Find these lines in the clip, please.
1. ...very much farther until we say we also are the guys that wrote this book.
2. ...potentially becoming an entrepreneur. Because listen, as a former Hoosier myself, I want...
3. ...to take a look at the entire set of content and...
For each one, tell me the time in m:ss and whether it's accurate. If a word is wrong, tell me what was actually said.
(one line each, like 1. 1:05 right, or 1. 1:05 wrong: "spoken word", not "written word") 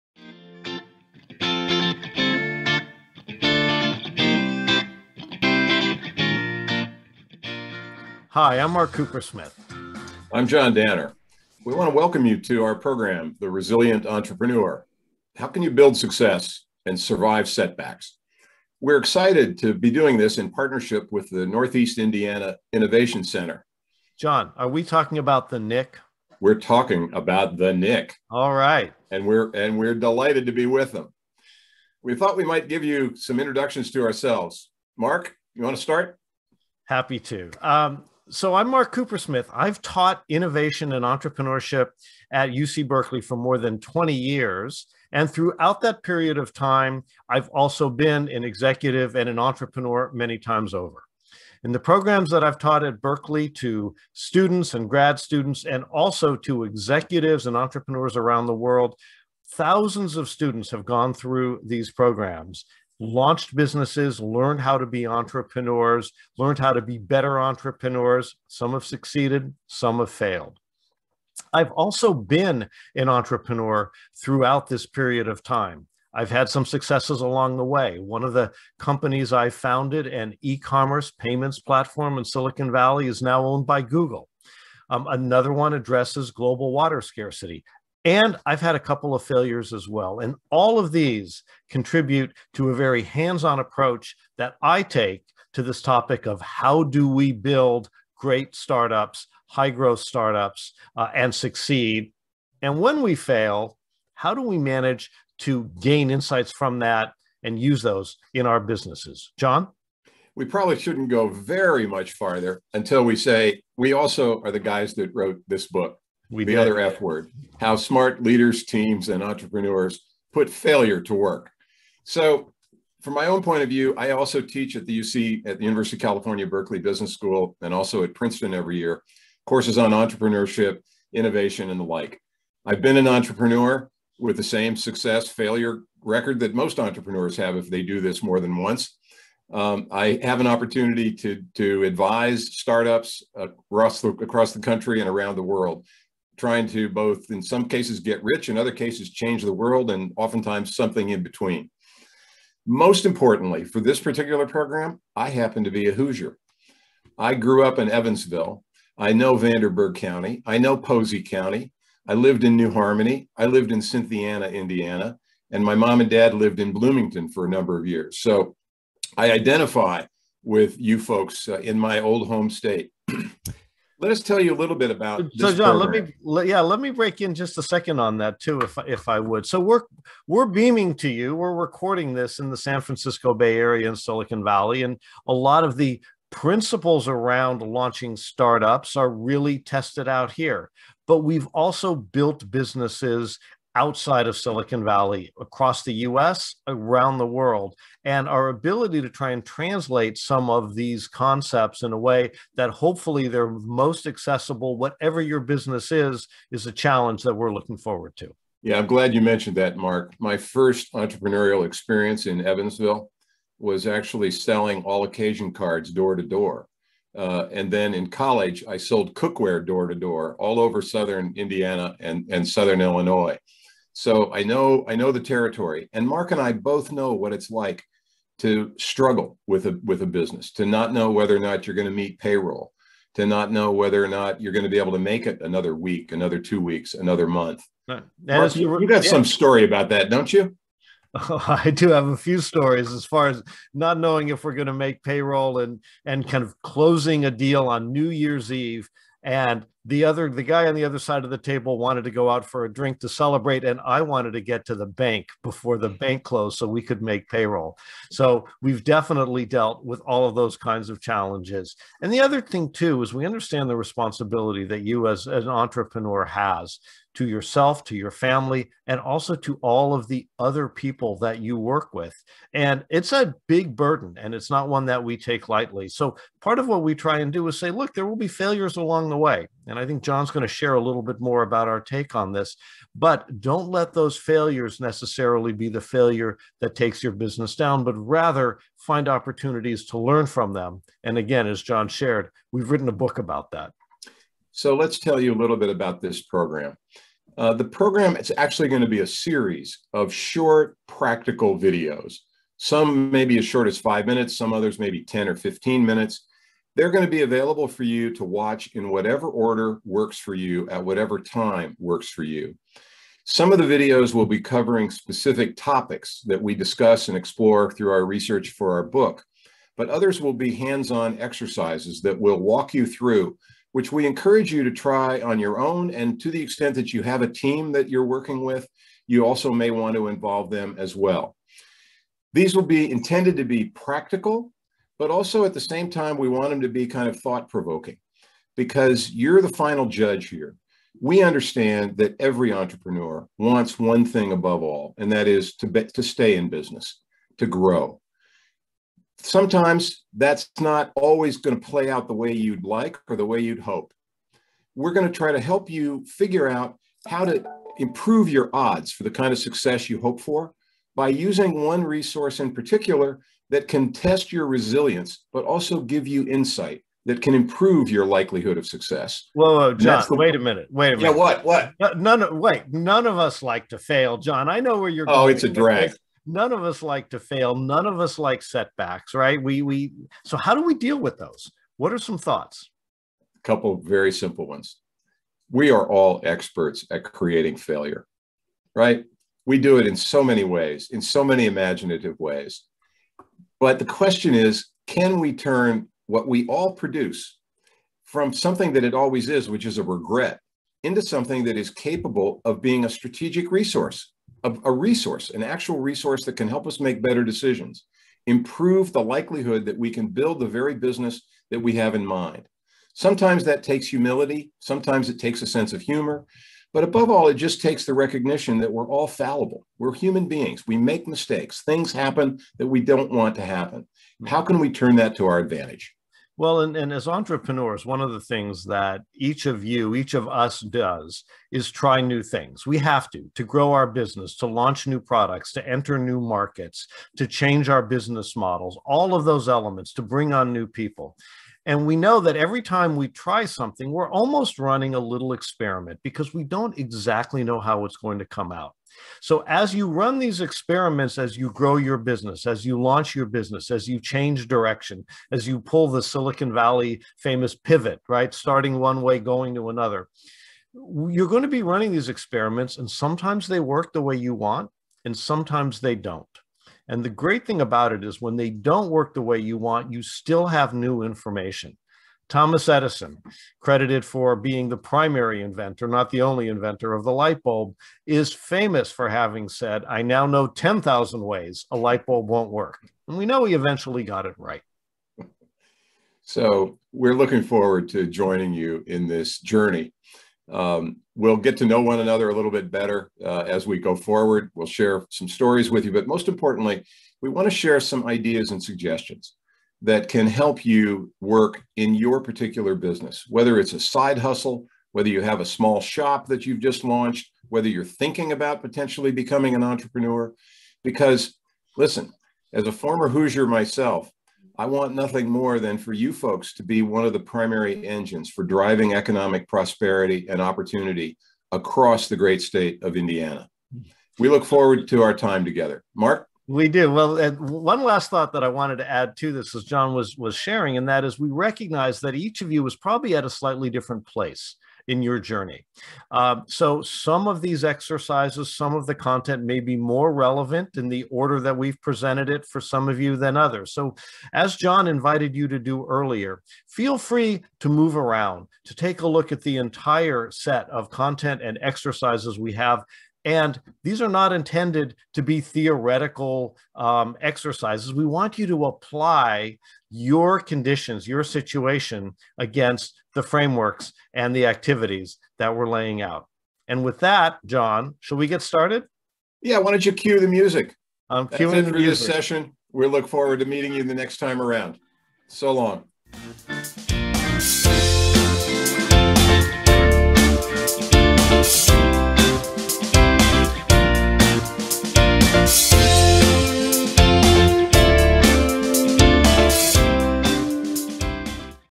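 1. 1:51 right
2. 8:28 right
3. 9:08 right.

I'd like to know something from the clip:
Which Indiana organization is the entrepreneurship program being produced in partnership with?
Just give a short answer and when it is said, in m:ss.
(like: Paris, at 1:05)
Northeast Indiana Innovation Center, at 0:21.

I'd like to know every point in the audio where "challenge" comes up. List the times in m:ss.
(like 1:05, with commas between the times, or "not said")
3:26, 4:21.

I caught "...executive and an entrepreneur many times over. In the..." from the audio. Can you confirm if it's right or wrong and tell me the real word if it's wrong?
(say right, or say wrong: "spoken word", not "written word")
right.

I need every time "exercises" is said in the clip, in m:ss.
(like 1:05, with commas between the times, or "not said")
5:21, 8:57, 9:11, 9:17.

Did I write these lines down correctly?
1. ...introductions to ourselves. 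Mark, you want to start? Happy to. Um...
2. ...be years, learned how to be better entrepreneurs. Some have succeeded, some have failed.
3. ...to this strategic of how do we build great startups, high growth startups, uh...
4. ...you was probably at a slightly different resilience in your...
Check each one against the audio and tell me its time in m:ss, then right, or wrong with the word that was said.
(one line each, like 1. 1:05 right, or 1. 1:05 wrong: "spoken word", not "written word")
1. 0:33 right
2. 1:04 wrong: "entrepreneurs", not "years"
3. 1:35 wrong: "topic", not "strategic"
4. 8:52 wrong: "place", not "resilience".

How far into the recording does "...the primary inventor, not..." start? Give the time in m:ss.
7:54.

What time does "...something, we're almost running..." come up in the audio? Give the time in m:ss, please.
7:23.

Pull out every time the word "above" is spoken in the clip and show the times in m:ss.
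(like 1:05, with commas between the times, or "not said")
5:44, 6:56.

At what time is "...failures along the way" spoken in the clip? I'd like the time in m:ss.
4:38.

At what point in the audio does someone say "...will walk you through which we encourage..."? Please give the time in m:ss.
5:22.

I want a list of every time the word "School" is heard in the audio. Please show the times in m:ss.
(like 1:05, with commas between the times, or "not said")
2:07.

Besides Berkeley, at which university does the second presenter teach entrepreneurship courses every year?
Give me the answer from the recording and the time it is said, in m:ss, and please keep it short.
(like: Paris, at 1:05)
Princeton, at 2:08.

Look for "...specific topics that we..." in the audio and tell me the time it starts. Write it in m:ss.
5:14.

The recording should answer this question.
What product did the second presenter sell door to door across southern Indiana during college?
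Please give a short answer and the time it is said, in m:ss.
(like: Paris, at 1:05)
Cookware, at 3:39.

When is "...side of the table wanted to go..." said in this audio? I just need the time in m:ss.
4:10.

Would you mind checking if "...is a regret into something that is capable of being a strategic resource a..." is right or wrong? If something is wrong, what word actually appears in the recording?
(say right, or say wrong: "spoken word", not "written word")
right.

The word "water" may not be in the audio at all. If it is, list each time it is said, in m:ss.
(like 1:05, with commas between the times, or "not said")
1:26.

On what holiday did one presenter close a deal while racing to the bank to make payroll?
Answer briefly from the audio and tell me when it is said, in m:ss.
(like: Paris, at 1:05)
New Year's Eve, at 4:07.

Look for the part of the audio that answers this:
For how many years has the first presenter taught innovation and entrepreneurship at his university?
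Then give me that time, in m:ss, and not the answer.
0:43.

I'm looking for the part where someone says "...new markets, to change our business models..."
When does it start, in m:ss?
7:15.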